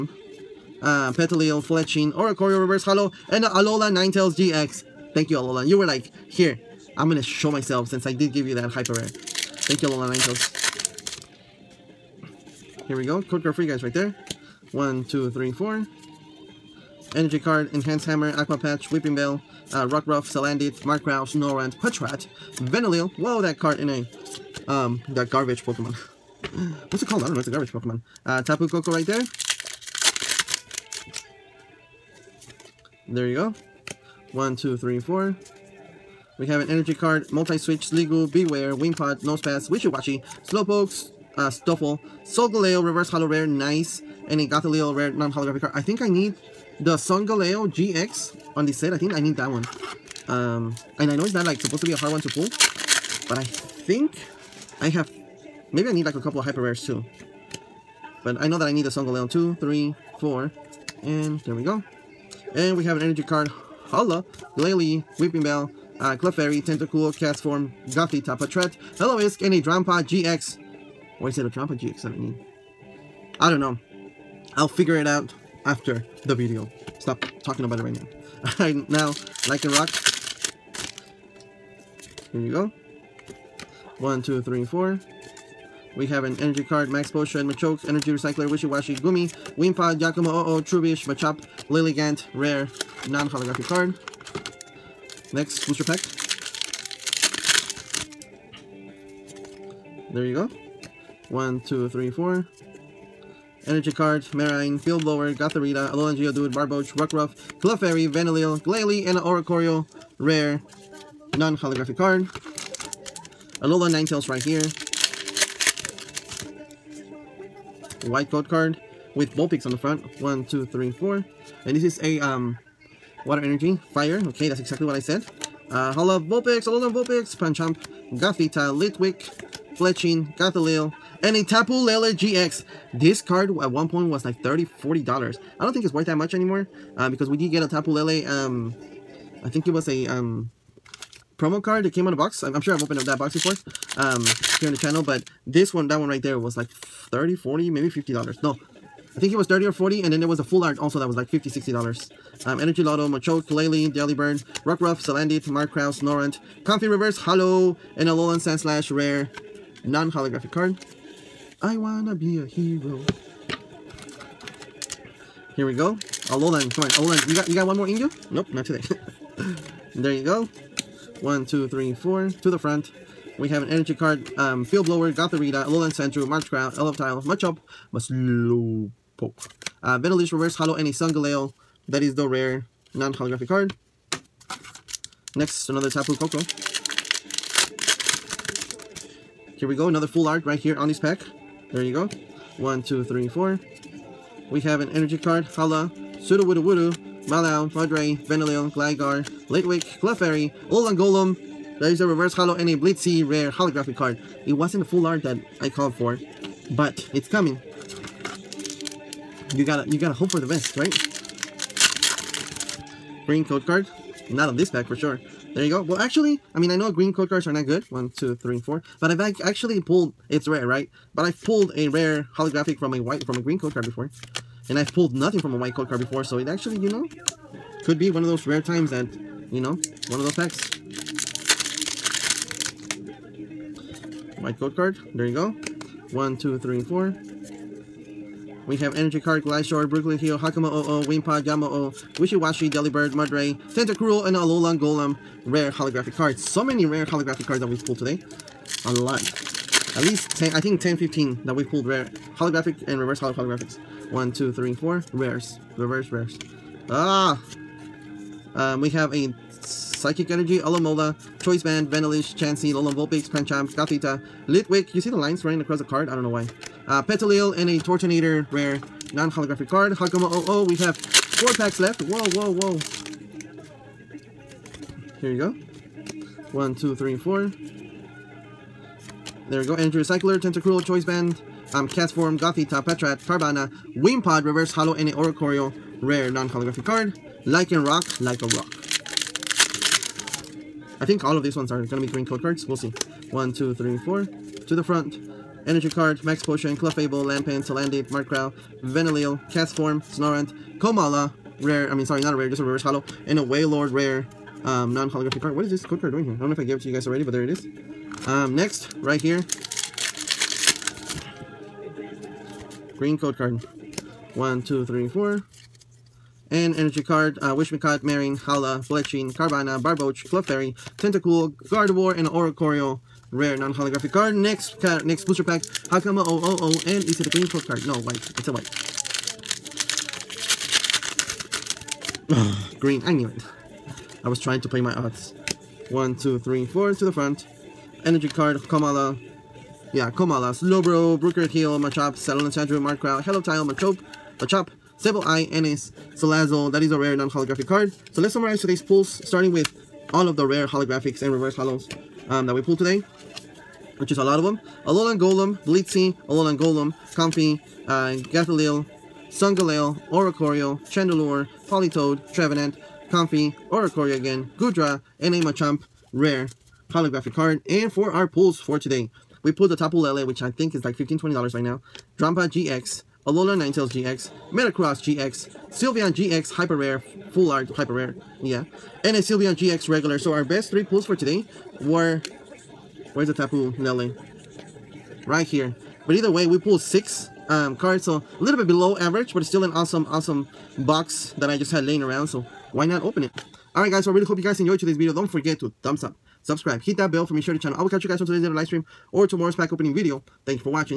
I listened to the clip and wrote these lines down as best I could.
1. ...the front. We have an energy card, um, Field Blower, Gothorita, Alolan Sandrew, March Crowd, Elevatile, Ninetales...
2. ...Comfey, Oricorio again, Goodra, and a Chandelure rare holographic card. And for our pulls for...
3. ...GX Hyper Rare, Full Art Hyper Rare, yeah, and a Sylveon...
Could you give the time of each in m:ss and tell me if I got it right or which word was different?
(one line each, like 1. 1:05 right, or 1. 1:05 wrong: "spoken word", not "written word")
1. 2:52 wrong: "Machop", not "Ninetales"
2. 6:03 wrong: "Machamp", not "Chandelure"
3. 6:16 right.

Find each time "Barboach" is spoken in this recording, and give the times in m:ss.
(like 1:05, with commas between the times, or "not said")
1:46, 5:19.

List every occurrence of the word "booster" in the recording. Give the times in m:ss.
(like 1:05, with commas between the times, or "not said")
1:35, 5:25.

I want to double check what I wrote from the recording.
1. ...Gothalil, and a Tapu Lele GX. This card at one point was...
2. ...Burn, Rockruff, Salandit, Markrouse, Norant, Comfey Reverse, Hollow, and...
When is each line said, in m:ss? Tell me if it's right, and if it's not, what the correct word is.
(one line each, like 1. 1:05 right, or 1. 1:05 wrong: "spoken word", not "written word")
1. 2:10 right
2. 2:34 right.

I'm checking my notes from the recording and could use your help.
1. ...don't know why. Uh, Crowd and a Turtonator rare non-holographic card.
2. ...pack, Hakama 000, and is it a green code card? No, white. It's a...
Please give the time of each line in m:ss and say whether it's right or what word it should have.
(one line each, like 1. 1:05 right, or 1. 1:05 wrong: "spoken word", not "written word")
1. 4:26 wrong: "Petilil", not "Crowd"
2. 5:25 right.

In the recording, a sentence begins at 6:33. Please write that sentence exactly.
Alright guys, so I really hope you guys enjoyed today's video.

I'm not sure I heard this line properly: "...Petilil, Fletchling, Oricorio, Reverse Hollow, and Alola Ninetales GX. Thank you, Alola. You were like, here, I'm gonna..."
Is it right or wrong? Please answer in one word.
right.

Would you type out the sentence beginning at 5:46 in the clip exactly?
That is a rare non-holographic card.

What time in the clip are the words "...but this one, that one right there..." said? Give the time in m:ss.
2:25.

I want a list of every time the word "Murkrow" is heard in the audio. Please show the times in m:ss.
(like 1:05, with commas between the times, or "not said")
0:20, 5:42.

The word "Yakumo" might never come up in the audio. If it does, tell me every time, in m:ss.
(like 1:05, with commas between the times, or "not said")
1:29.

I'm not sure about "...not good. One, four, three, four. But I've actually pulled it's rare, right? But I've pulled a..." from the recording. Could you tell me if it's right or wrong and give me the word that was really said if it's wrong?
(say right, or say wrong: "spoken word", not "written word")
wrong: "two", not "four".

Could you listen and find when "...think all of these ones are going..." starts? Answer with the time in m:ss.
4:51.